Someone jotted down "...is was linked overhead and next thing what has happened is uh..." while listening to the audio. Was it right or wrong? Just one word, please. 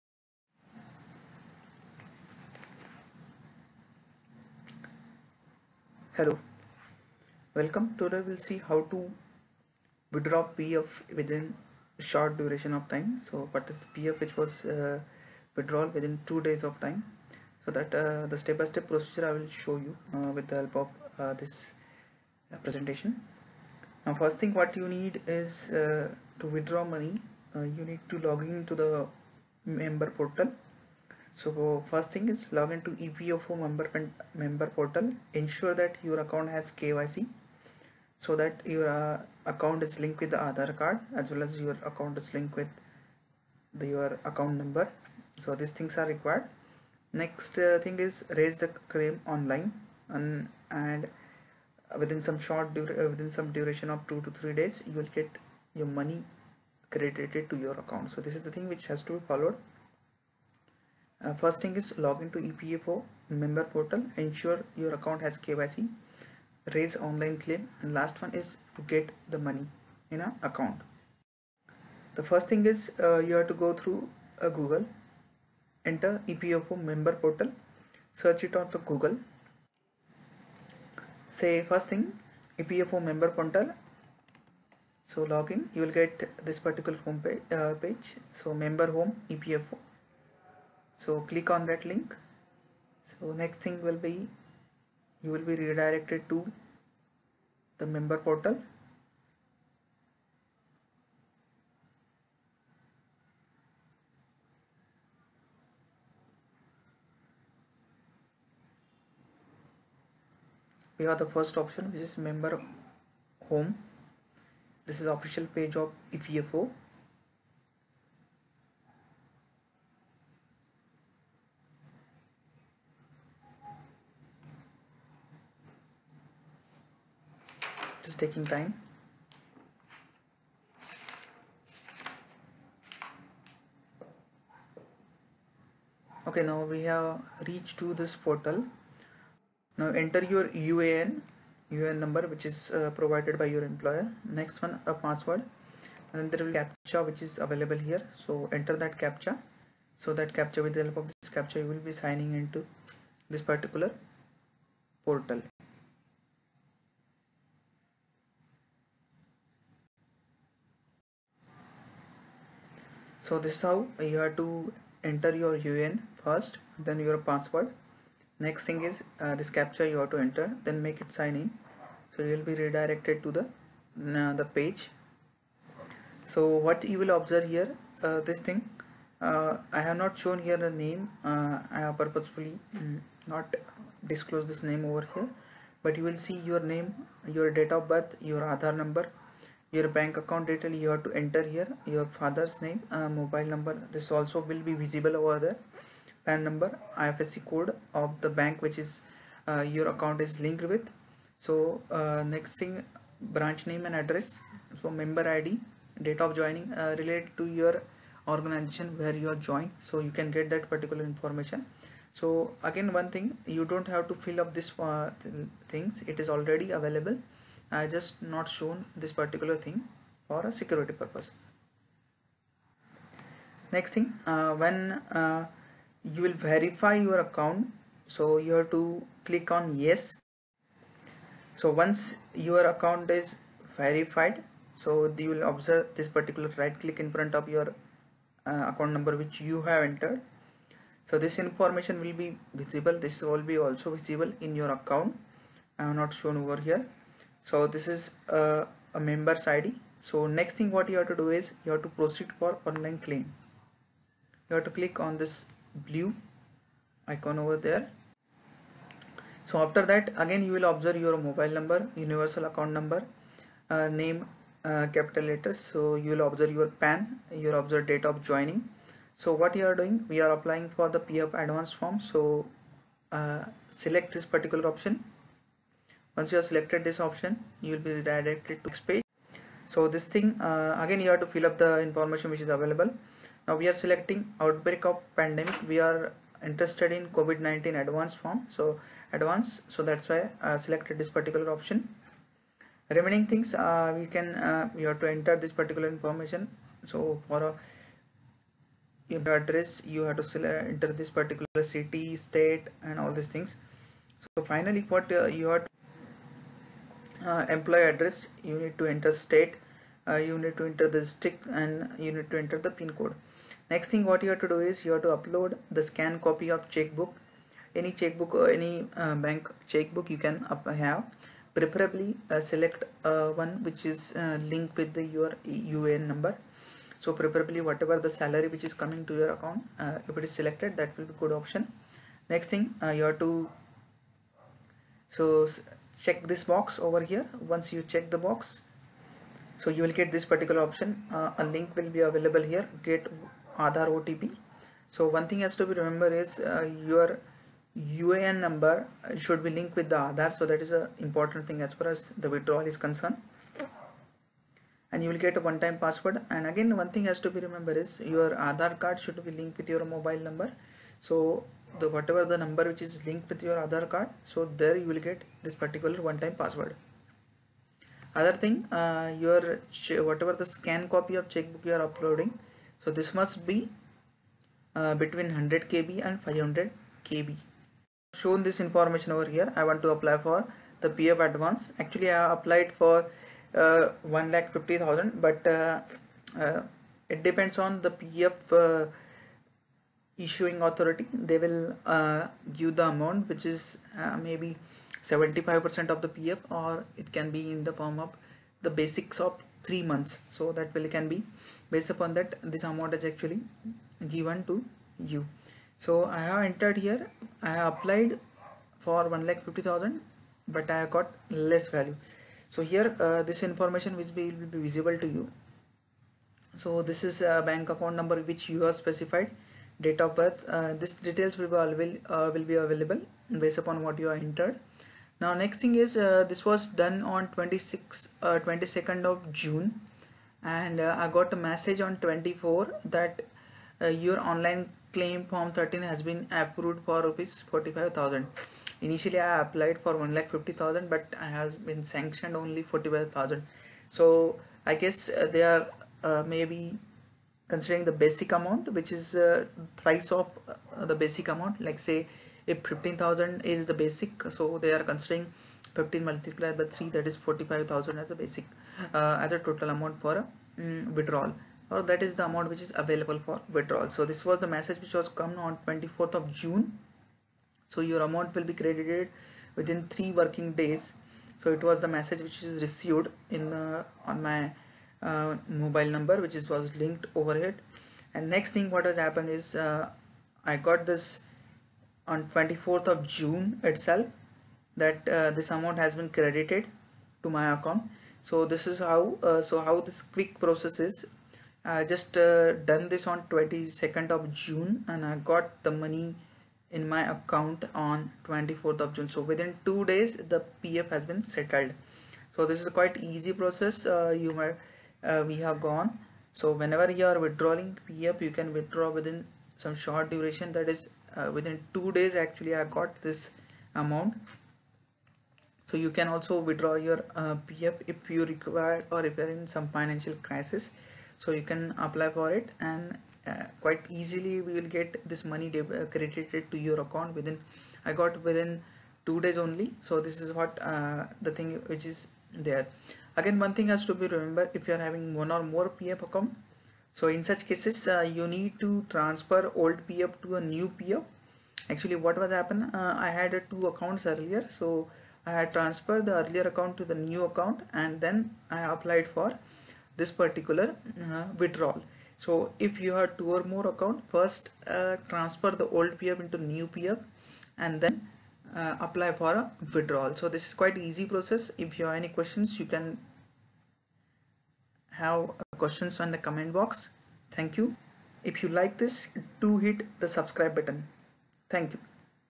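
right.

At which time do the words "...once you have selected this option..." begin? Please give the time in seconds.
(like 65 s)
276 s.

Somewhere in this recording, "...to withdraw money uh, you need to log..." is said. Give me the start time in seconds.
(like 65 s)
26 s.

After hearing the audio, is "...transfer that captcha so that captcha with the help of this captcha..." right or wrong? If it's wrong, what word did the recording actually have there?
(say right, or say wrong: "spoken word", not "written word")
wrong: "enter", not "transfer".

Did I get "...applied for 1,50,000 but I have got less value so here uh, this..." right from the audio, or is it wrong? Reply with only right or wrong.
right.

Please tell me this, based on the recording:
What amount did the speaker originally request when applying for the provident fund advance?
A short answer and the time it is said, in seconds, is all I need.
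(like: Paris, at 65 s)
1,50,000 rupees, at 384 s.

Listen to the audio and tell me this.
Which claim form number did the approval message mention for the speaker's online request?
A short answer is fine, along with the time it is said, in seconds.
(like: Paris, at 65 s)
Form 13, at 435 s.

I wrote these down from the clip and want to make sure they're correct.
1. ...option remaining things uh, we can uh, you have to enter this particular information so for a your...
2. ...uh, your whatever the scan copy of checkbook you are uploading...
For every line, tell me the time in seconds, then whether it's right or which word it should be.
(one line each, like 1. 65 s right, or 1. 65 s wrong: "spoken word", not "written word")
1. 291 s right
2. 368 s right.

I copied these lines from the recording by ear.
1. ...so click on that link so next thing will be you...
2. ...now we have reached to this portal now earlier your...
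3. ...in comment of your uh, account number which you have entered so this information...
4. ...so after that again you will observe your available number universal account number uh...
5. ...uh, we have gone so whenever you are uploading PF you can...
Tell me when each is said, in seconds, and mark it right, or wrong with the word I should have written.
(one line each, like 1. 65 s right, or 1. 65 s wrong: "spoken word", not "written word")
1. 91 s right
2. 136 s wrong: "enter", not "earlier"
3. 236 s wrong: "front", not "comment"
4. 259 s wrong: "mobile", not "available"
5. 505 s wrong: "withdrawing", not "uploading".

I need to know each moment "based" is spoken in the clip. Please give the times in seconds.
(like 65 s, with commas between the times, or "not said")
401 s, 423 s.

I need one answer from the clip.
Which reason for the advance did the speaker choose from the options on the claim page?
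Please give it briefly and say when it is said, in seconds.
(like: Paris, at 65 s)
Outbreak of pandemic (COVID-19), at 284 s.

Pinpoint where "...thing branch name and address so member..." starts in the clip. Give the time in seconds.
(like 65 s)
202 s.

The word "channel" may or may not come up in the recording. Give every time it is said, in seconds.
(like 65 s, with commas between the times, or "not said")
not said.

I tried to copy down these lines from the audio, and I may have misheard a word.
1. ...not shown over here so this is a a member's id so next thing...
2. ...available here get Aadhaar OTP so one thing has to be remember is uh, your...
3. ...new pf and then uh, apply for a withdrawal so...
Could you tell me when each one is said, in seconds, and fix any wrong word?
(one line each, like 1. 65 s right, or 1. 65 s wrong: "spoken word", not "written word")
1. 245 s right
2. 341 s right
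3. 556 s right.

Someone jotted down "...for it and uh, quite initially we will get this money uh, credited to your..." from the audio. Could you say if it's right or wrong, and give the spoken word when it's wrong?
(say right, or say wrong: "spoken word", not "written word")
wrong: "easily", not "initially".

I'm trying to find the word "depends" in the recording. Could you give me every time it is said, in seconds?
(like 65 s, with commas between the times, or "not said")
387 s.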